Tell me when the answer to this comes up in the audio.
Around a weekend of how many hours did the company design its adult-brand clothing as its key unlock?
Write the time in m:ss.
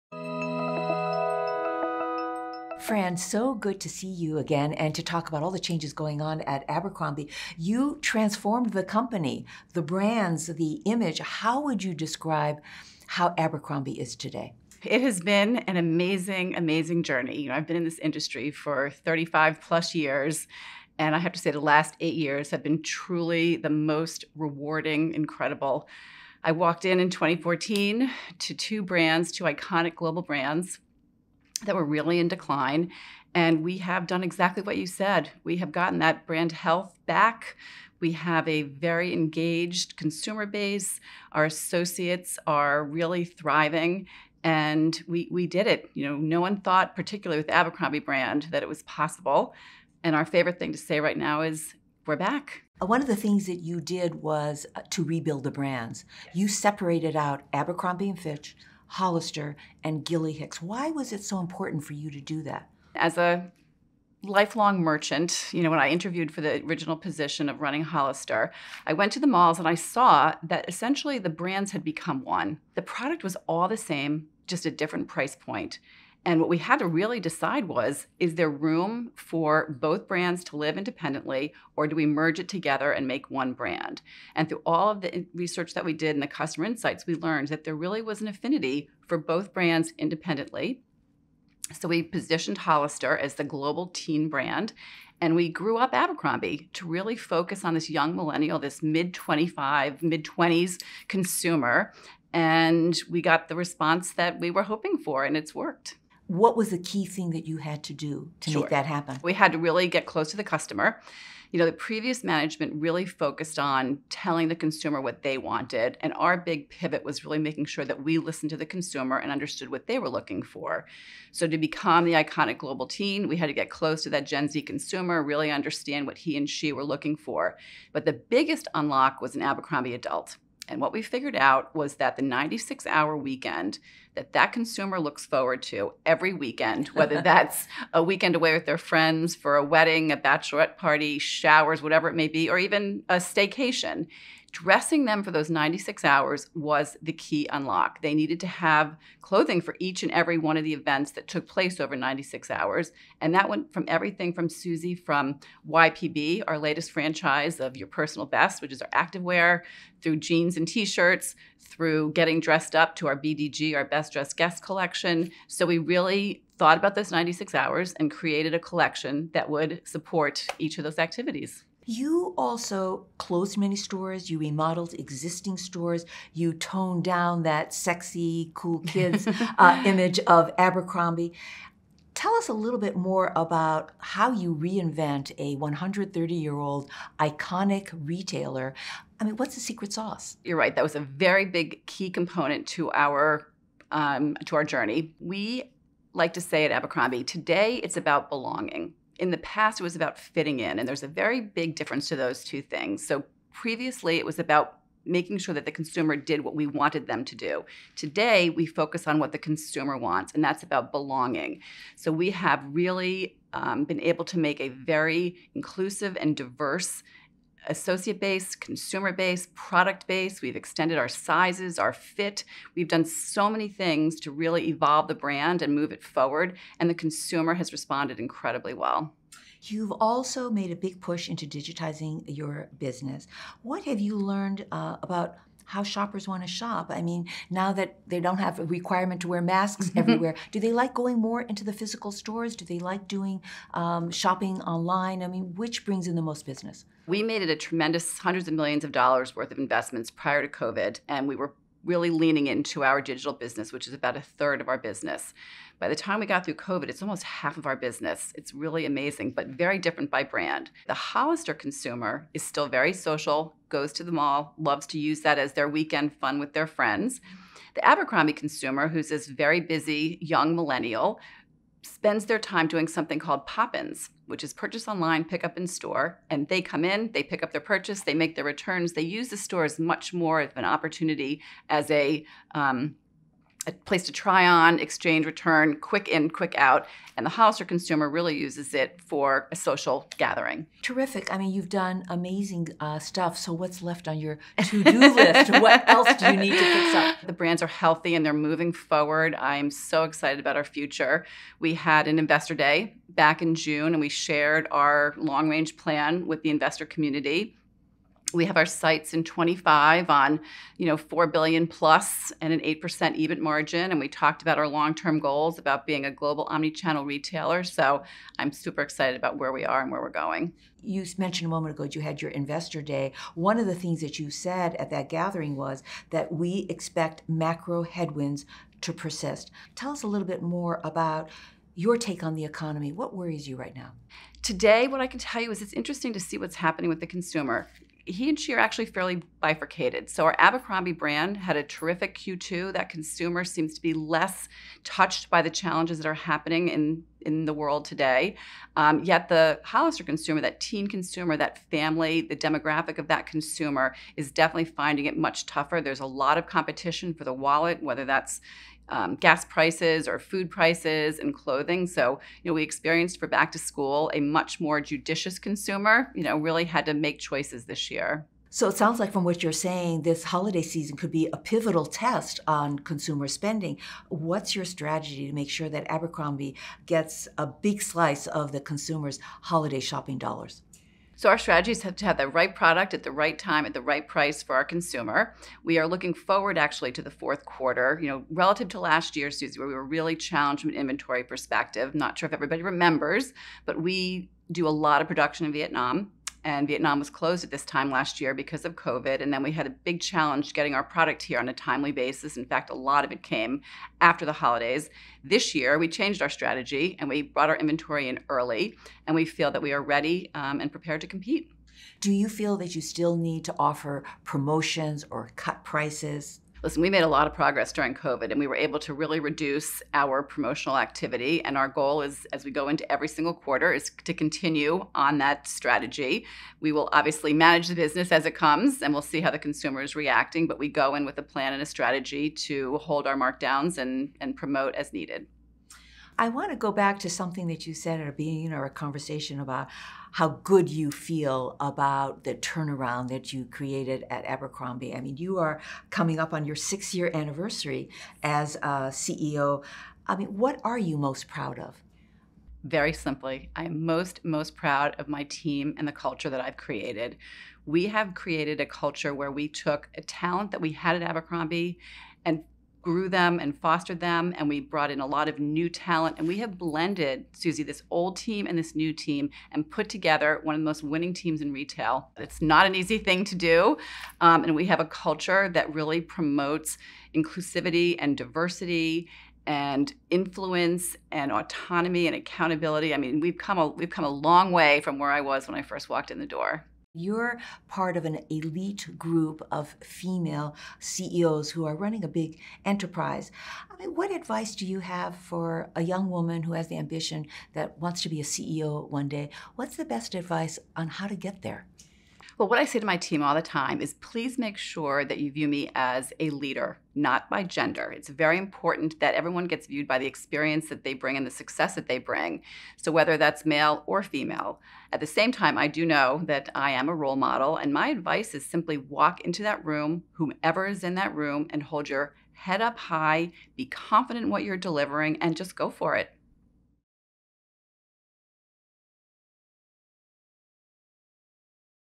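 2:12.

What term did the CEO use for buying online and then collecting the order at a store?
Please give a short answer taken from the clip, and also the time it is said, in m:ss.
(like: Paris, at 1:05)
pop-ins, at 4:33.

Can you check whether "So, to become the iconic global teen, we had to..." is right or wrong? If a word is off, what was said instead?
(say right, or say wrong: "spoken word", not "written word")
right.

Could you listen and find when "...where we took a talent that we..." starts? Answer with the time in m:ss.
7:39.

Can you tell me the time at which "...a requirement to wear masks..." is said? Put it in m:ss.
3:58.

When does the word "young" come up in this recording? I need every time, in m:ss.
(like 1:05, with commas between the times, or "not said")
1:37, 4:30, 8:15.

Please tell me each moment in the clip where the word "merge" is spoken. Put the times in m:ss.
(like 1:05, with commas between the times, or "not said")
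1:22.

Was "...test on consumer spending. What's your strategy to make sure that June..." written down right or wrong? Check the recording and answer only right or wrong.
wrong.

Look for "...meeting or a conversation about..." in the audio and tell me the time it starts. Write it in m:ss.
7:18.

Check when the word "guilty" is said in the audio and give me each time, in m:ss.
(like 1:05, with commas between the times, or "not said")
not said.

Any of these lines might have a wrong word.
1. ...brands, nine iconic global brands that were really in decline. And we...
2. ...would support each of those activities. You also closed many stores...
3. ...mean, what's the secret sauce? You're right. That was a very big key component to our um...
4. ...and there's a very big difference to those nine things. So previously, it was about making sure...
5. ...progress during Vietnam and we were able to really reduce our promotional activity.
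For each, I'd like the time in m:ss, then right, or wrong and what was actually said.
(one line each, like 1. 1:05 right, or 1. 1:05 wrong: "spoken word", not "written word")
1. 0:28 wrong: "two", not "nine"
2. 2:49 right
3. 3:09 right
4. 3:20 wrong: "two", not "nine"
5. 6:57 wrong: "COVID", not "Vietnam".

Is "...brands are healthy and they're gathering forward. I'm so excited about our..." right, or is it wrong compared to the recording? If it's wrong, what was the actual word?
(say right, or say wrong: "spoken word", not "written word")
wrong: "moving", not "gathering".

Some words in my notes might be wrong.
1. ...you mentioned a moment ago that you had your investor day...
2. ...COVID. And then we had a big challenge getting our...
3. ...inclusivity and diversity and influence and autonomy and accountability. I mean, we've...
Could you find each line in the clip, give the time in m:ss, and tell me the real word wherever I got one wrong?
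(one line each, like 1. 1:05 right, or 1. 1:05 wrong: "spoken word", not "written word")
1. 5:20 right
2. 6:38 right
3. 7:57 right.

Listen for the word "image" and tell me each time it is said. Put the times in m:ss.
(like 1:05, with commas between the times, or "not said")
0:10, 2:59.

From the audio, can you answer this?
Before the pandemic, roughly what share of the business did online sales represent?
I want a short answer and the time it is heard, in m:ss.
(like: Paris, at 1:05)
a third, at 4:13.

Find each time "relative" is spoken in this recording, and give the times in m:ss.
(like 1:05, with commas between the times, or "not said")
6:28.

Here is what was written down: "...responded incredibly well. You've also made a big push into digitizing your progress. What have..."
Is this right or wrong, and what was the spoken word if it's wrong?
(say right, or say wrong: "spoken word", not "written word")
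wrong: "business", not "progress".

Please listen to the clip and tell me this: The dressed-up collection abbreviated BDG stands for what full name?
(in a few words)
Best Dressed Guest.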